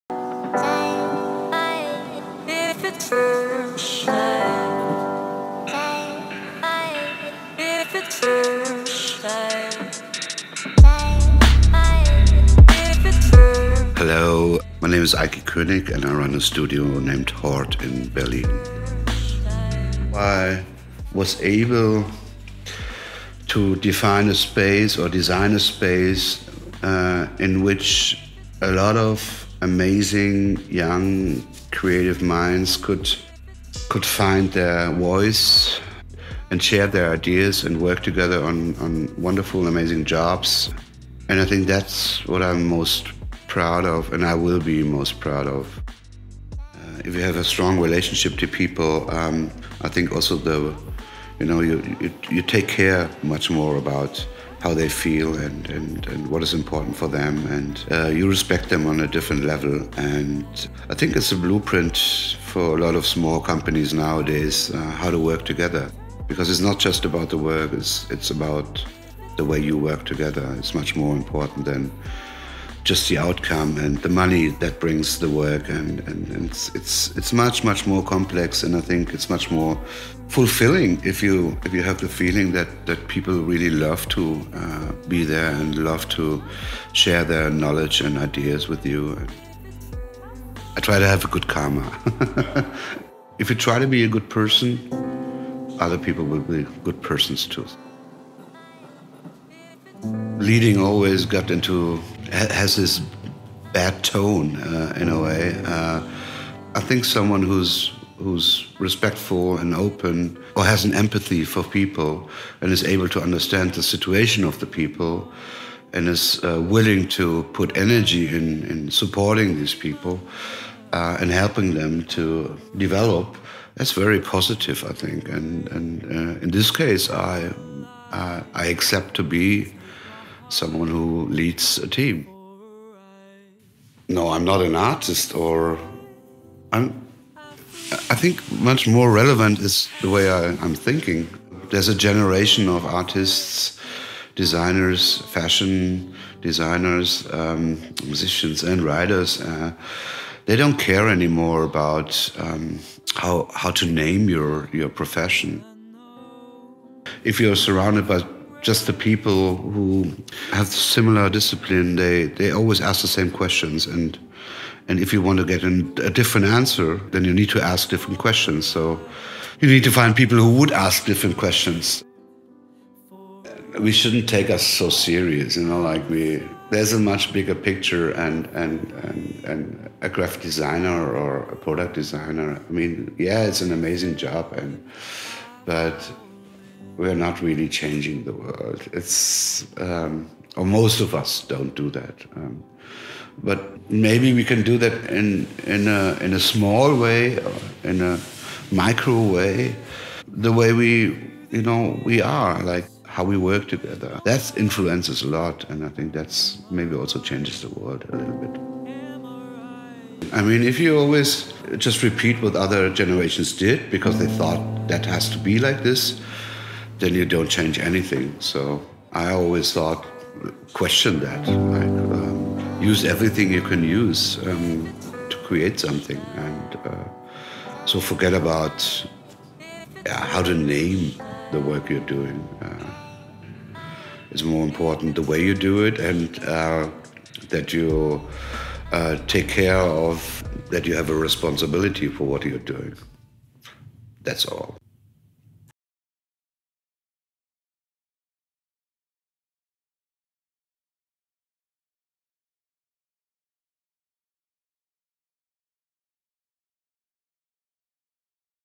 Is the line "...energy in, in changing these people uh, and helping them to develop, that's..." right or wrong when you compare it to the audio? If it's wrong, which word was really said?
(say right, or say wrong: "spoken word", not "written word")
wrong: "supporting", not "changing".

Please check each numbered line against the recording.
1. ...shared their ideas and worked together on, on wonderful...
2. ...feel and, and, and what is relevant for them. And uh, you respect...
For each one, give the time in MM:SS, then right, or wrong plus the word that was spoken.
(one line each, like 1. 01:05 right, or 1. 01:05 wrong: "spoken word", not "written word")
1. 00:36 right
2. 00:54 wrong: "important", not "relevant".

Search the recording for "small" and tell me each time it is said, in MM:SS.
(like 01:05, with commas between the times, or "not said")
01:03, 03:16.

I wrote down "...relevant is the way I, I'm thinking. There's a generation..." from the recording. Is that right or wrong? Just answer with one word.
right.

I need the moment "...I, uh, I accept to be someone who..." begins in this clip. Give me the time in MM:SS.
02:07.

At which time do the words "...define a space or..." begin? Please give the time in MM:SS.
00:23.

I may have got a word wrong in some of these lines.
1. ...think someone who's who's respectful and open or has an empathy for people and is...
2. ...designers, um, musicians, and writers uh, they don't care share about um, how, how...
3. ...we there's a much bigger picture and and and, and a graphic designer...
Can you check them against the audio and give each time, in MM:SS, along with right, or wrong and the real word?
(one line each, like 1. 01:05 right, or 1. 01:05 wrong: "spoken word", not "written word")
1. 01:46 right
2. 02:26 wrong: "anymore", not "share"
3. 02:56 right.